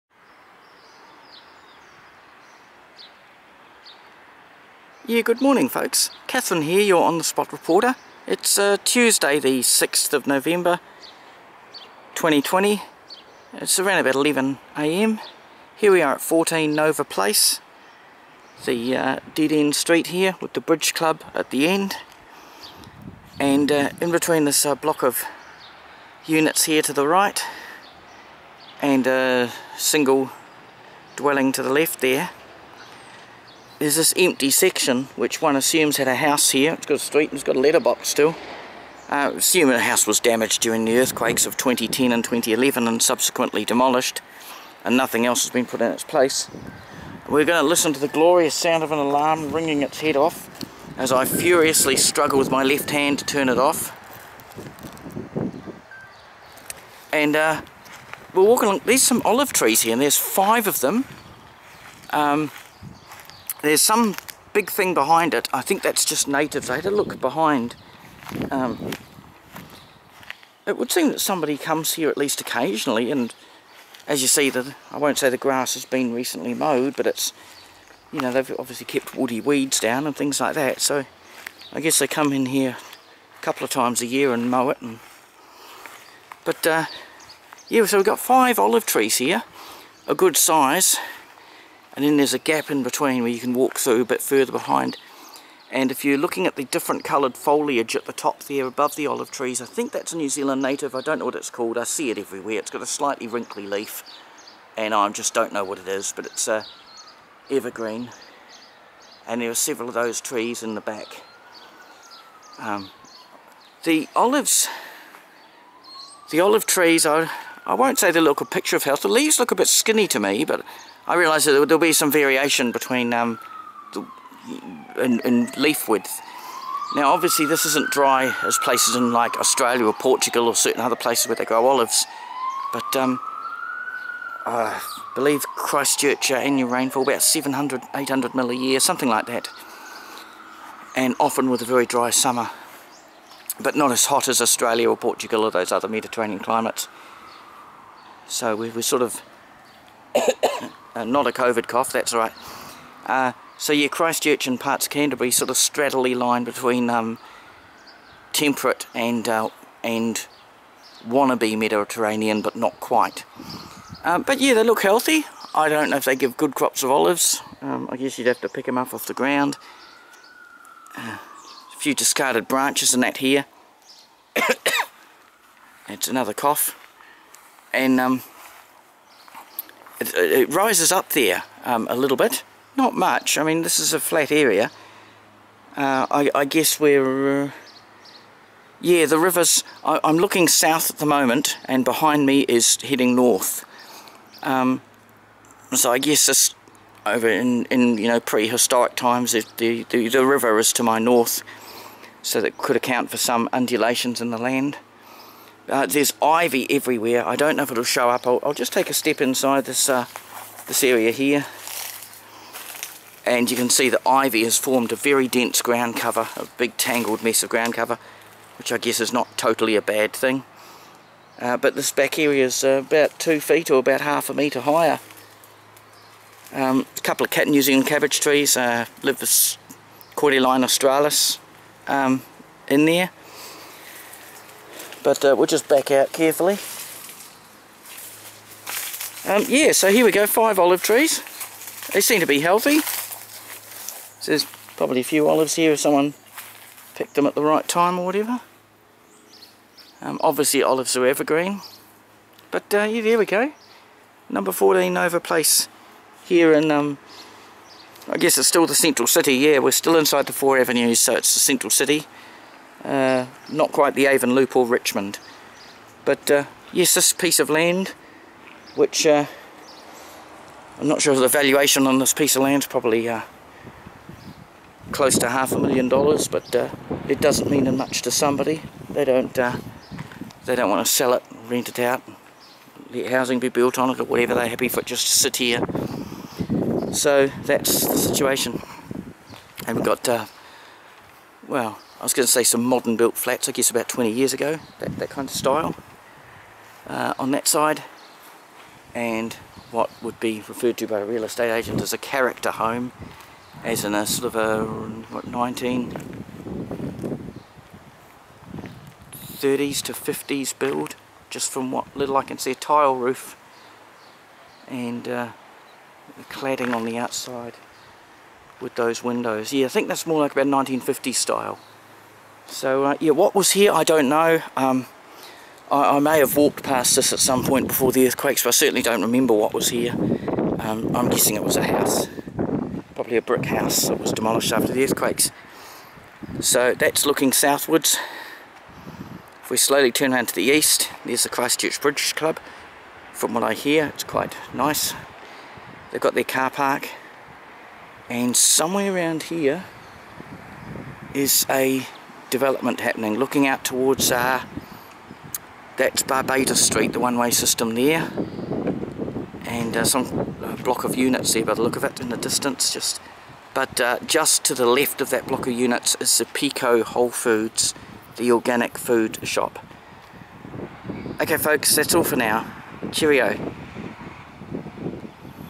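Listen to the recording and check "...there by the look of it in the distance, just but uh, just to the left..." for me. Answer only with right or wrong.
right.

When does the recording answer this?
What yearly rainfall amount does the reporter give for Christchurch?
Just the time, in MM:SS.
02:17.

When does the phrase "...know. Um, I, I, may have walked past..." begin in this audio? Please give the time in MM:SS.
05:24.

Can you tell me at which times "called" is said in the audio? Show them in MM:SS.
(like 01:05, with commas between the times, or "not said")
01:41.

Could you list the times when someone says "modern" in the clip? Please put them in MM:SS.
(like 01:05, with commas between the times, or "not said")
04:52.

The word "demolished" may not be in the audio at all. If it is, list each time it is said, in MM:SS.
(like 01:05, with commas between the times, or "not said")
00:43, 05:34.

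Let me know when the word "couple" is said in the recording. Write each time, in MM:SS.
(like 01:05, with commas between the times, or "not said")
01:23, 03:47.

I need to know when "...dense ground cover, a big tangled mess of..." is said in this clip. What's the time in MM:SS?
03:35.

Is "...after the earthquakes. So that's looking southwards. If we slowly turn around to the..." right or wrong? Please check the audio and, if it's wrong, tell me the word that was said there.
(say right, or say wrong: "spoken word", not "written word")
right.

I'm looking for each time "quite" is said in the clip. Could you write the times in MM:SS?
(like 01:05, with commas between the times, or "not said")
02:42, 04:23, 05:44.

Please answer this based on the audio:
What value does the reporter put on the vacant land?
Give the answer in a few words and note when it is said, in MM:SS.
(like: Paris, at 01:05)
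Half a million dollars, at 04:35.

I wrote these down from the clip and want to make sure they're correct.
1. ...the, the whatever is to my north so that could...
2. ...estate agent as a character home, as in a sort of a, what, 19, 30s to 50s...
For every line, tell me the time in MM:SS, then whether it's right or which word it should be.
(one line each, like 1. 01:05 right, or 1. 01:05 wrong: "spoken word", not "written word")
1. 03:19 wrong: "river", not "whatever"
2. 05:01 right.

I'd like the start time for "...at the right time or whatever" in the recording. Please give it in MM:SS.
04:07.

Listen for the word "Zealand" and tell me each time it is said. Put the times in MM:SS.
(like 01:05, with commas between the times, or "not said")
01:40, 03:47.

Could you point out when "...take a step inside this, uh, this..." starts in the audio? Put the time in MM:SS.
03:28.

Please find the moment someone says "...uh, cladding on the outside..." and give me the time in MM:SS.
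05:15.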